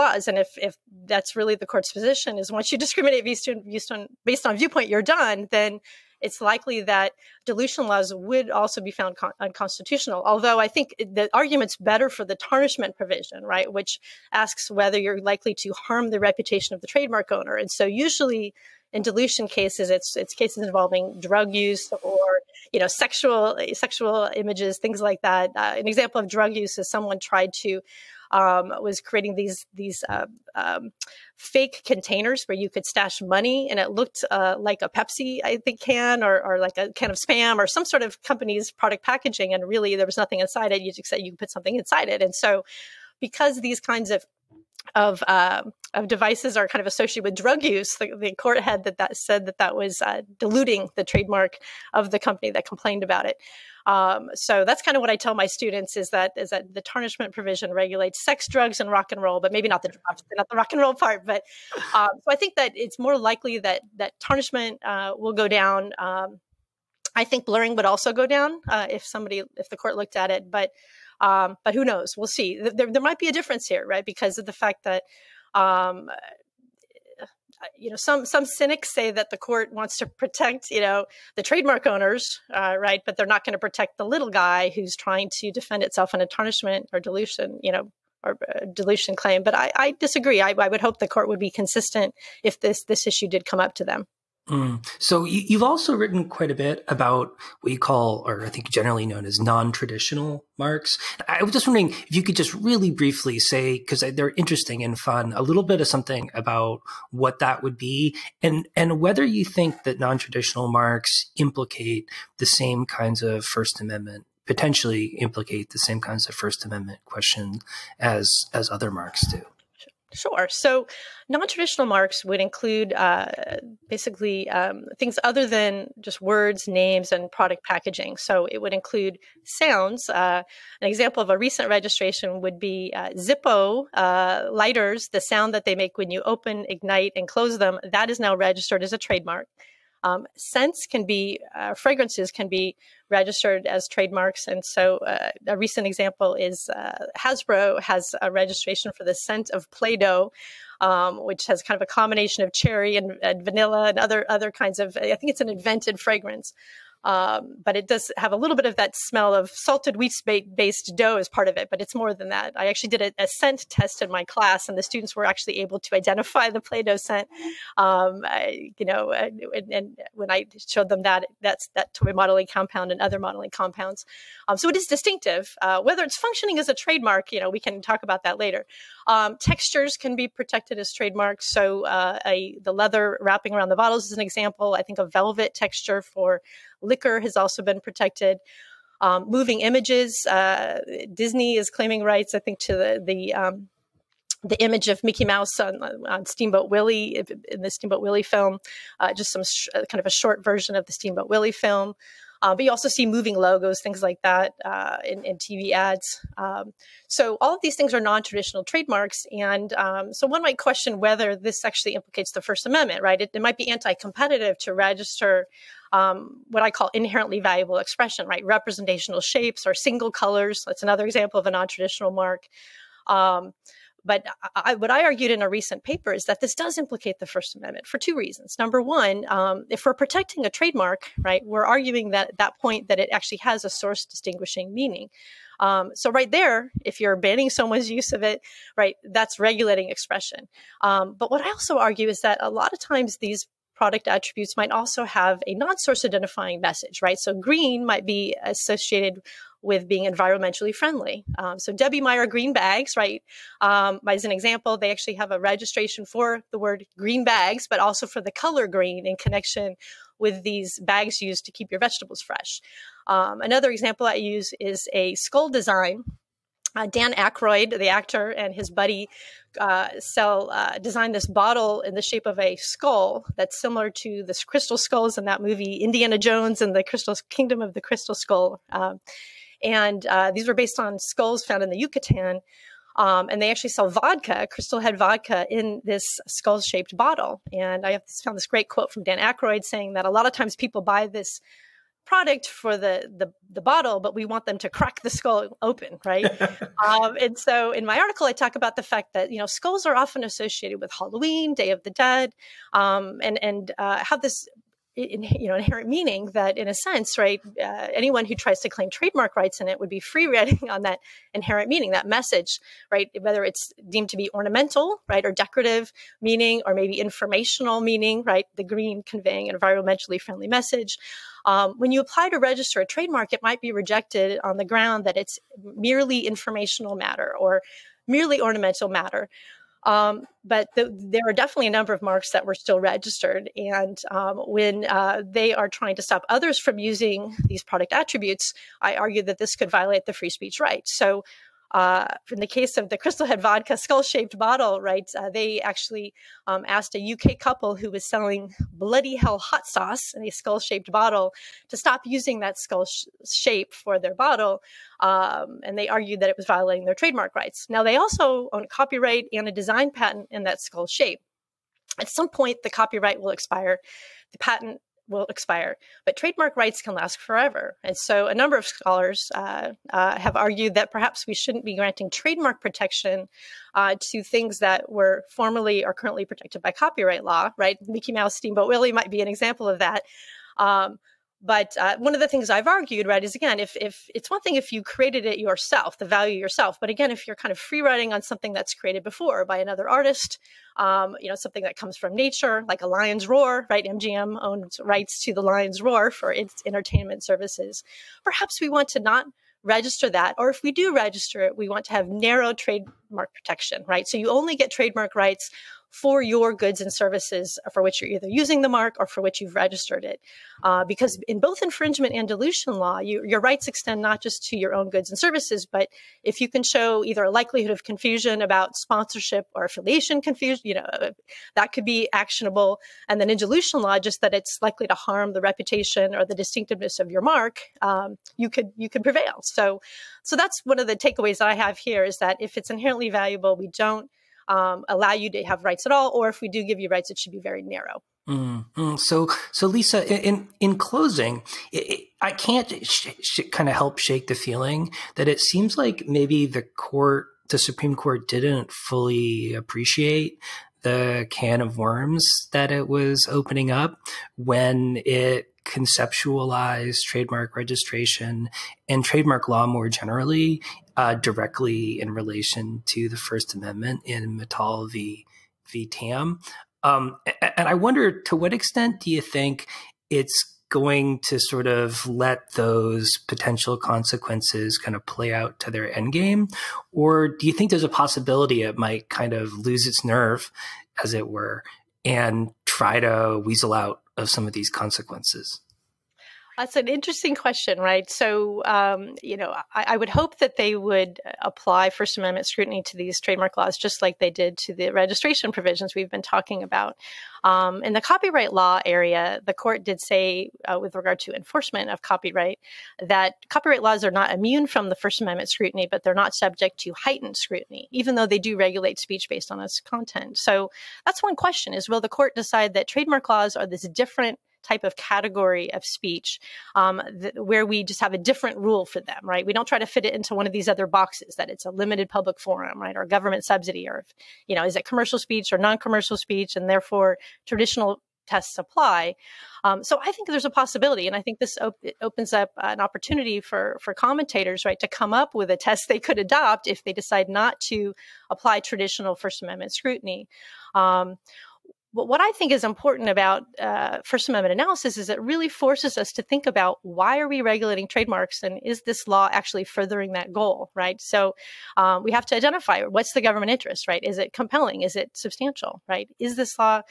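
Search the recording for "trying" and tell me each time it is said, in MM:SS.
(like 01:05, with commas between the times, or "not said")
01:24, 05:35.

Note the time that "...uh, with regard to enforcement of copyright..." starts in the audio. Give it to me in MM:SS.
08:20.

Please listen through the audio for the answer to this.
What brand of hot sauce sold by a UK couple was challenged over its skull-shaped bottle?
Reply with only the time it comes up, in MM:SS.
05:48.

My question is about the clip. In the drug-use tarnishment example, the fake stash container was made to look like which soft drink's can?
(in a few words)
Pepsi.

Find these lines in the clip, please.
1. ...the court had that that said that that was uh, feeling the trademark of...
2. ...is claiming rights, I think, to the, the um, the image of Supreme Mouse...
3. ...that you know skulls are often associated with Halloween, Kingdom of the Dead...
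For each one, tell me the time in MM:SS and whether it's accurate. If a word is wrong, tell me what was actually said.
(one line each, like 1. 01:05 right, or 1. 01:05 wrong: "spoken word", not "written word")
1. 00:48 wrong: "diluting", not "feeling"
2. 03:11 wrong: "Mickey", not "Supreme"
3. 04:59 wrong: "Day", not "Kingdom".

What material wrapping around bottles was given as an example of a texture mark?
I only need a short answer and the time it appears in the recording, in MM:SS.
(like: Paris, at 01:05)
leather, at 03:02.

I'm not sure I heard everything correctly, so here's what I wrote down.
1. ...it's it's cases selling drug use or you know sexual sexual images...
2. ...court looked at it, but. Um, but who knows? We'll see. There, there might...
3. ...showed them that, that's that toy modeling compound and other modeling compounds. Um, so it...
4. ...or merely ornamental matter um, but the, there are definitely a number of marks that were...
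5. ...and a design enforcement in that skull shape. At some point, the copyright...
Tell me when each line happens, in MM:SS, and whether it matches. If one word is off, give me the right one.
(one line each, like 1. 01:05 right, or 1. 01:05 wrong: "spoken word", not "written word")
1. 00:19 wrong: "involving", not "selling"
2. 01:09 right
3. 02:50 right
4. 05:27 right
5. 05:59 wrong: "patent", not "enforcement".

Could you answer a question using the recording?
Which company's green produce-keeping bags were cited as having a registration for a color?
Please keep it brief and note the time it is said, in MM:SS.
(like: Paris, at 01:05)
Debbie Meyer, at 04:11.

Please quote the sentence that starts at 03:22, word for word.
Uh, but you also see moving logos, things like that uh, in, in, TV ads.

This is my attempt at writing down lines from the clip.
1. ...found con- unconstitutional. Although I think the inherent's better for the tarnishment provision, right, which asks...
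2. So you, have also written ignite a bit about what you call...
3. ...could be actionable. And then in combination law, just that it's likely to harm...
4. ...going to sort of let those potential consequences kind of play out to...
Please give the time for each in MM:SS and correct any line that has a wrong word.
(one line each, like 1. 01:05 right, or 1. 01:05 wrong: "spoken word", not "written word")
1. 00:08 wrong: "argument", not "inherent"
2. 01:34 wrong: "quite", not "ignite"
3. 07:01 wrong: "dilution", not "combination"
4. 07:50 right.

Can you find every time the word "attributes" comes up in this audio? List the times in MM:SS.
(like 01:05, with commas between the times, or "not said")
04:04, 05:37.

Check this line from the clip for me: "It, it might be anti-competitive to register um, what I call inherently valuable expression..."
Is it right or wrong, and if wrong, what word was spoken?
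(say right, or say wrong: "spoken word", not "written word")
right.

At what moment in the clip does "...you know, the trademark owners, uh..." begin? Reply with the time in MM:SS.
01:20.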